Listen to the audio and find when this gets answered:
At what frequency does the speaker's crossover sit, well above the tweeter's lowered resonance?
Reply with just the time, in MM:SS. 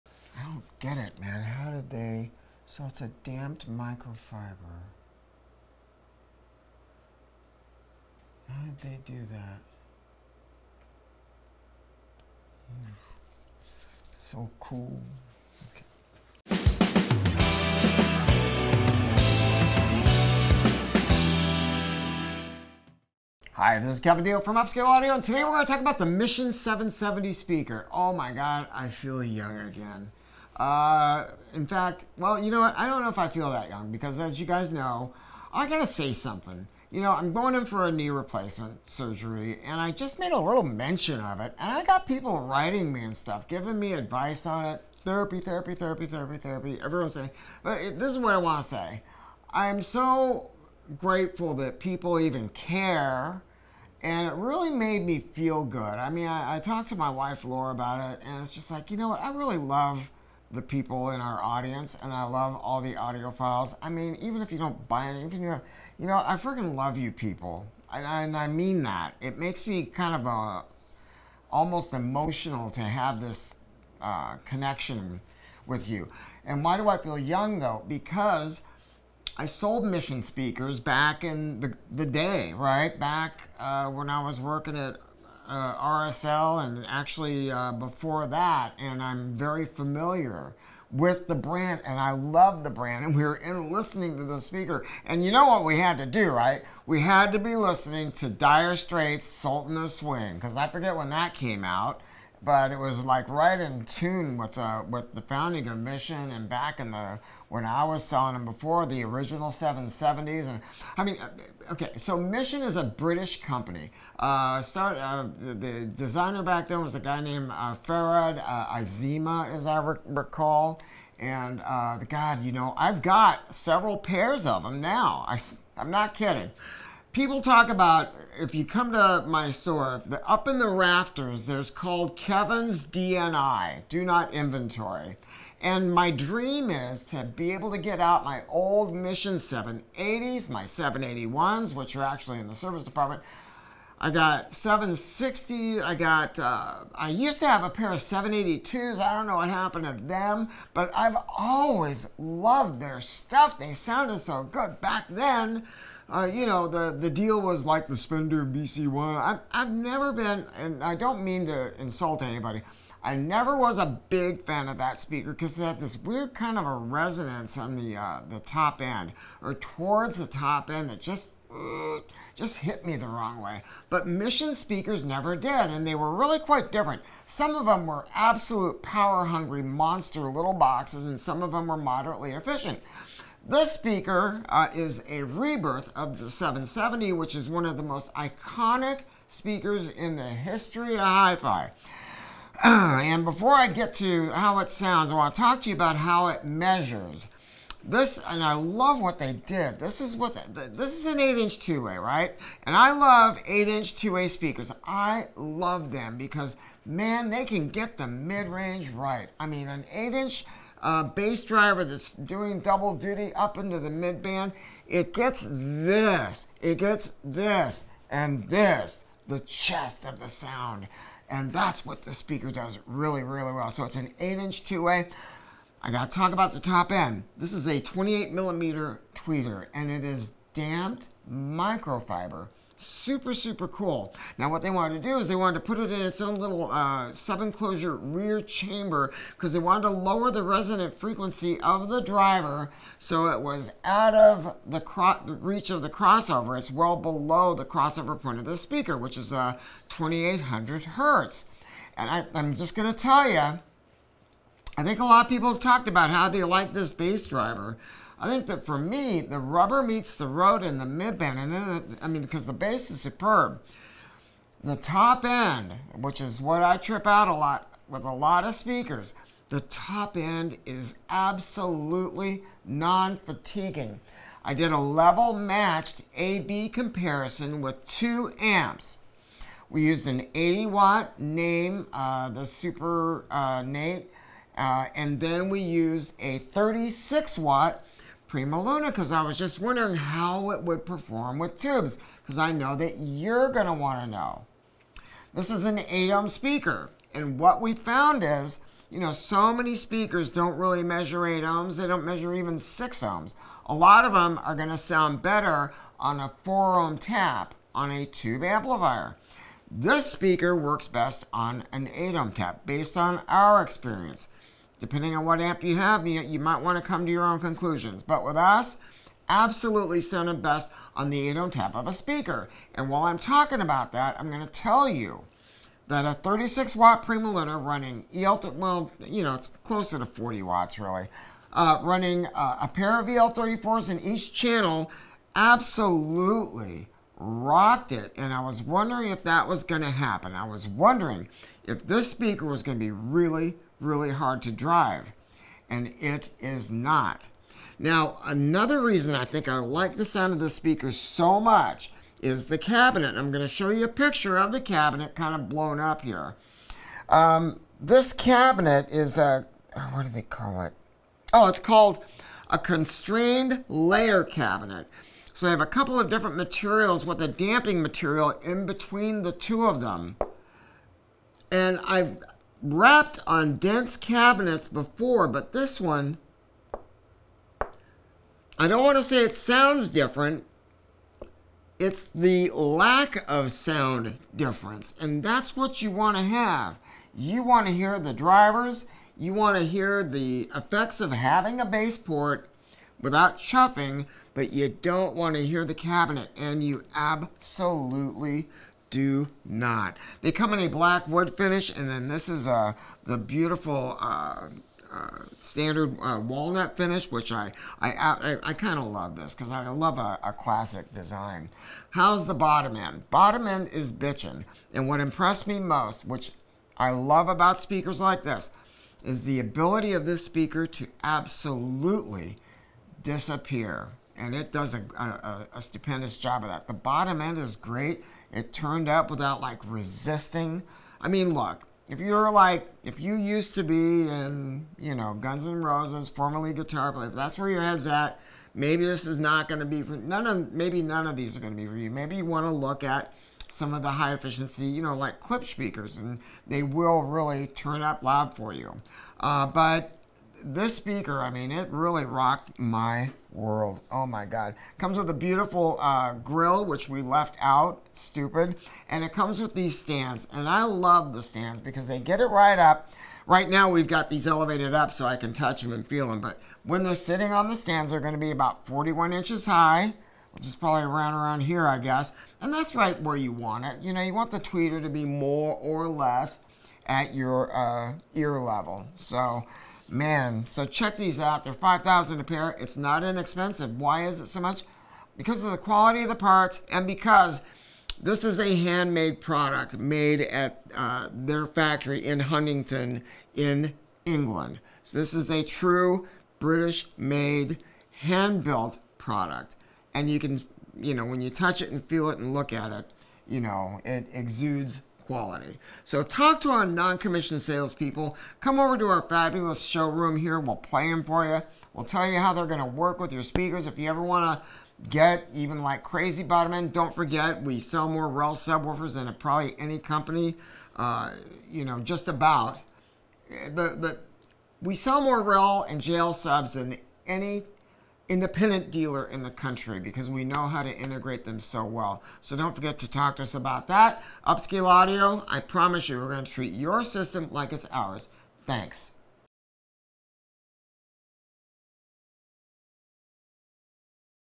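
04:09.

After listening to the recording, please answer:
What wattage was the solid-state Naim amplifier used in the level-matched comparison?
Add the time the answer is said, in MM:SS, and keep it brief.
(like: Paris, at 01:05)
80 watt, at 04:40.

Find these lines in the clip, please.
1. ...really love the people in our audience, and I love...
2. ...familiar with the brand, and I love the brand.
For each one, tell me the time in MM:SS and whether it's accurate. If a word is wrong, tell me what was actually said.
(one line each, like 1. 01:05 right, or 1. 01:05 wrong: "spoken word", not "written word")
1. 00:59 right
2. 01:29 right.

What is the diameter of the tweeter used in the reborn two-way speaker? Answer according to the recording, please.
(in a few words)
28 millimeter.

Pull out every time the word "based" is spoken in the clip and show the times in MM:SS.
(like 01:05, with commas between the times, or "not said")
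05:12.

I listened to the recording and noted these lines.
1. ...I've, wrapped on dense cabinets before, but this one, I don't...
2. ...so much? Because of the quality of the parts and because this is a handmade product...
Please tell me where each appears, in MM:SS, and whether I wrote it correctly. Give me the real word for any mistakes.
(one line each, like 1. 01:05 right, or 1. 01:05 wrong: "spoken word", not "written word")
1. 06:11 right
2. 08:04 right.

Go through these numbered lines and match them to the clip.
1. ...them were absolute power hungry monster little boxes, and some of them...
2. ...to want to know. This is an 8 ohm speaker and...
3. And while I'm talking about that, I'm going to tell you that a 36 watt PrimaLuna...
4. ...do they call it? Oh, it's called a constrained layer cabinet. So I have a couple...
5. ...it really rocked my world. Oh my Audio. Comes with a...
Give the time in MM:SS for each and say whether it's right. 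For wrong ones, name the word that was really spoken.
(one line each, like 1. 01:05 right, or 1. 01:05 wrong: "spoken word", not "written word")
1. 02:57 right
2. 04:53 right
3. 05:22 right
4. 06:00 right
5. 07:31 wrong: "God", not "Audio".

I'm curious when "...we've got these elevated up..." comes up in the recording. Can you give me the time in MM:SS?
07:43.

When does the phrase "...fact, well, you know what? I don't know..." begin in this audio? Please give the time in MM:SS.
00:31.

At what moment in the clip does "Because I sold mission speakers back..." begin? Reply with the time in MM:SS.
01:17.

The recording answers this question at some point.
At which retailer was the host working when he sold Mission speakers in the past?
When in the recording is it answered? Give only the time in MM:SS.
01:25.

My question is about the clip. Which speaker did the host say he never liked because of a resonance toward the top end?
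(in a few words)
Spendor BC One.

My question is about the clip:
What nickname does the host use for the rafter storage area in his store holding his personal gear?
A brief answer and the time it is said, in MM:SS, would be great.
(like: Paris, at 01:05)
kevin's dni, at 02:12.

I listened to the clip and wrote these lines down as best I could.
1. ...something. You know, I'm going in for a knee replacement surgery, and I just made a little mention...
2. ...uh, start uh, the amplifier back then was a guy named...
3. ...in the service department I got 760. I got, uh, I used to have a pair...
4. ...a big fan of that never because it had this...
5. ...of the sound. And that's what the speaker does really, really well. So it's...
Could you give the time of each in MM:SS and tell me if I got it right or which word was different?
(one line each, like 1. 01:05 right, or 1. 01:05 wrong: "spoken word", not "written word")
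1. 00:36 right
2. 01:54 wrong: "designer", not "amplifier"
3. 02:22 right
4. 02:43 wrong: "speaker", not "never"
5. 03:40 right.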